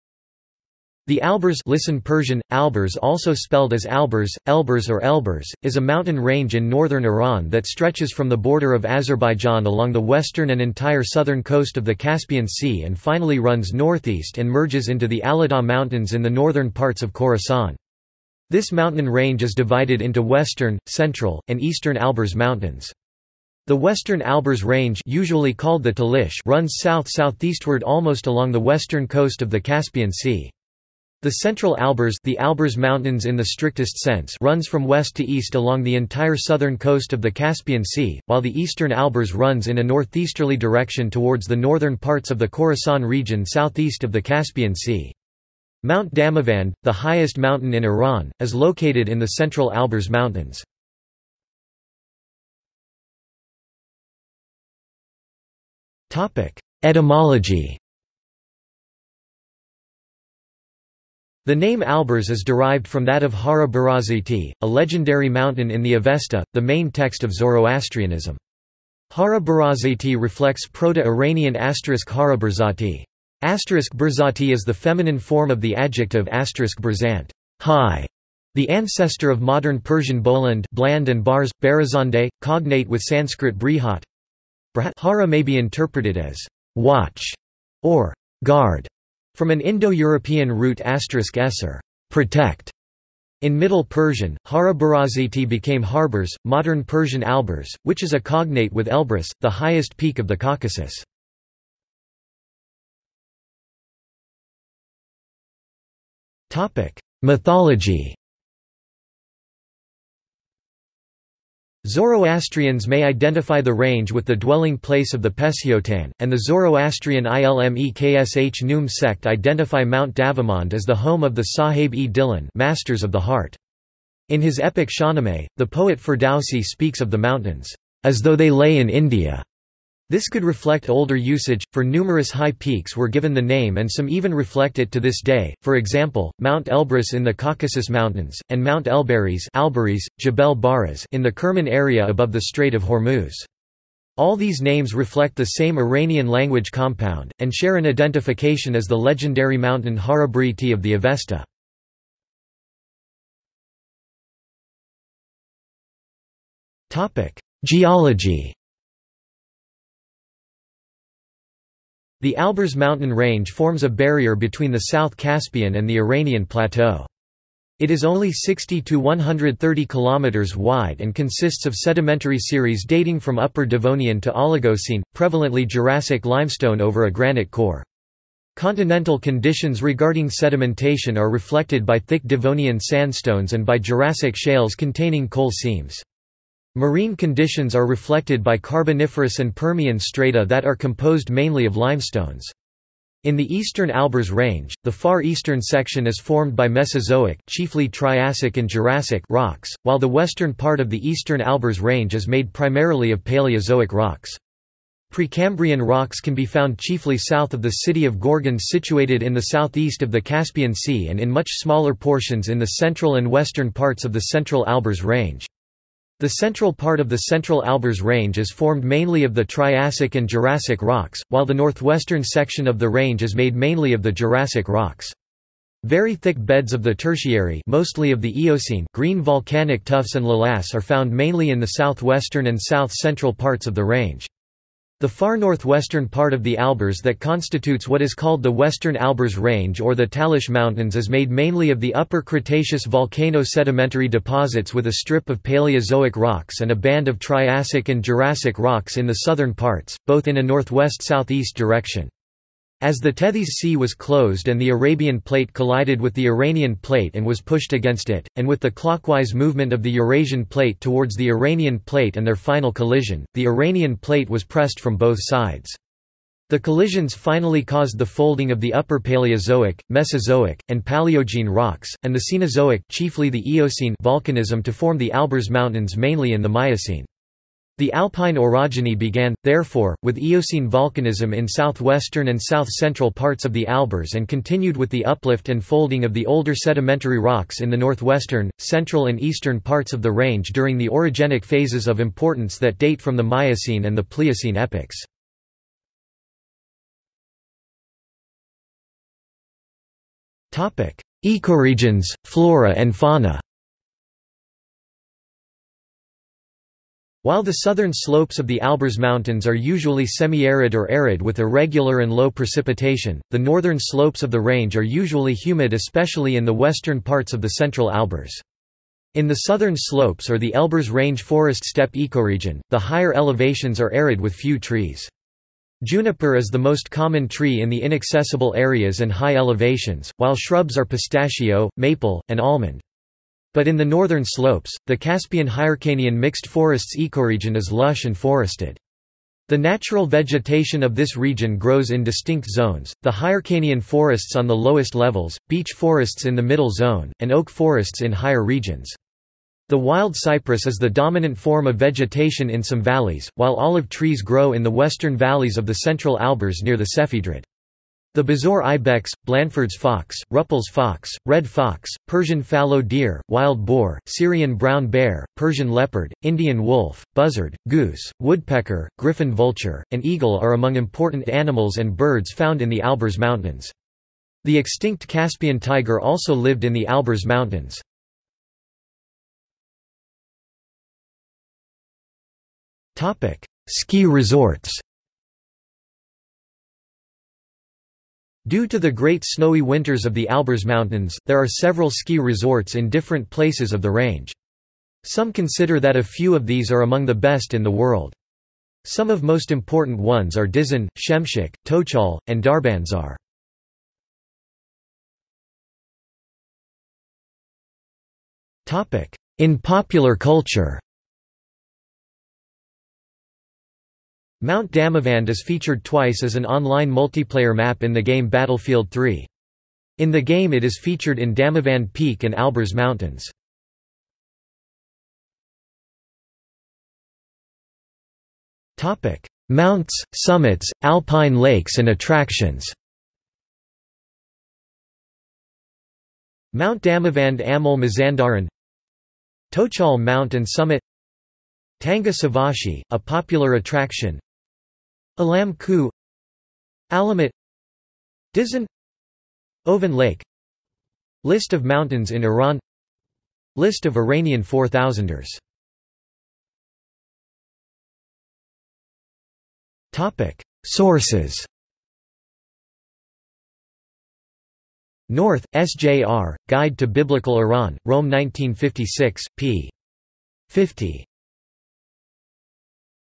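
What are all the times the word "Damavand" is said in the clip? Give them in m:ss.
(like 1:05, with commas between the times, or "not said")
0:46, 2:00, 6:54, 7:01, 7:16.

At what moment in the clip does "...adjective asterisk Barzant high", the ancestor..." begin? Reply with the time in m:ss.
1:15.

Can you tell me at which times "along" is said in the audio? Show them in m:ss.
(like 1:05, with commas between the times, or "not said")
0:09, 0:28, 0:35.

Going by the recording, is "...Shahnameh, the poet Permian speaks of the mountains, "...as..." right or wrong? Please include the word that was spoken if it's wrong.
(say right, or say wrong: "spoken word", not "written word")
wrong: "Ferdowsi", not "Permian".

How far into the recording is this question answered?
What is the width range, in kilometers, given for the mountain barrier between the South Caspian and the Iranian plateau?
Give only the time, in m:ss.
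2:48.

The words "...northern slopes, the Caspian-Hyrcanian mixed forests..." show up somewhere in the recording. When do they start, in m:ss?
5:33.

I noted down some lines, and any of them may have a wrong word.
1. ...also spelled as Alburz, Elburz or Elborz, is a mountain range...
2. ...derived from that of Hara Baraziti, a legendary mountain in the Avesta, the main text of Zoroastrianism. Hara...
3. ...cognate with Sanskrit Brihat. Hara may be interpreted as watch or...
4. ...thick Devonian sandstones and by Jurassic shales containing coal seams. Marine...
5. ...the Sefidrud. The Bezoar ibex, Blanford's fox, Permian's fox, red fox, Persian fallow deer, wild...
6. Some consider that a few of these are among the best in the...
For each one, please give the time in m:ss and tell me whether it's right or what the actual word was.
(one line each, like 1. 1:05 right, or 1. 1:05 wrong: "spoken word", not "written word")
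1. 0:03 right
2. 1:02 right
3. 1:22 right
4. 3:01 right
5. 5:56 wrong: "Rüppell", not "Permian"
6. 6:35 right.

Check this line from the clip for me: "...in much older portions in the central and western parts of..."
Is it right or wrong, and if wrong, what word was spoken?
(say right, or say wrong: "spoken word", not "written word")
wrong: "smaller", not "older".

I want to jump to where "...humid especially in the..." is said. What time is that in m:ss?
5:15.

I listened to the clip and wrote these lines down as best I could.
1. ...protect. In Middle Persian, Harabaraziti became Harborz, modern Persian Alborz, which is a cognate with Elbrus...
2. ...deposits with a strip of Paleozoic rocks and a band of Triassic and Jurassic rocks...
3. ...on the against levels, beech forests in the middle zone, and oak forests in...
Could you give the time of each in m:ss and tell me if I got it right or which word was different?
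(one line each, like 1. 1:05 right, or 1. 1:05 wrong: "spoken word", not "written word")
1. 1:32 right
2. 4:04 right
3. 5:44 wrong: "lowest", not "against".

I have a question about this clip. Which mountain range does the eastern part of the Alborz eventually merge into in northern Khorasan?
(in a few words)
Aladagh Mountains.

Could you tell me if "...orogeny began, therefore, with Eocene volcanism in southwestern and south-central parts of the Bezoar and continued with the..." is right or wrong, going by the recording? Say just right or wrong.
wrong.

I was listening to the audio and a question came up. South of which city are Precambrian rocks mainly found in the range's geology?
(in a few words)
Gorgan.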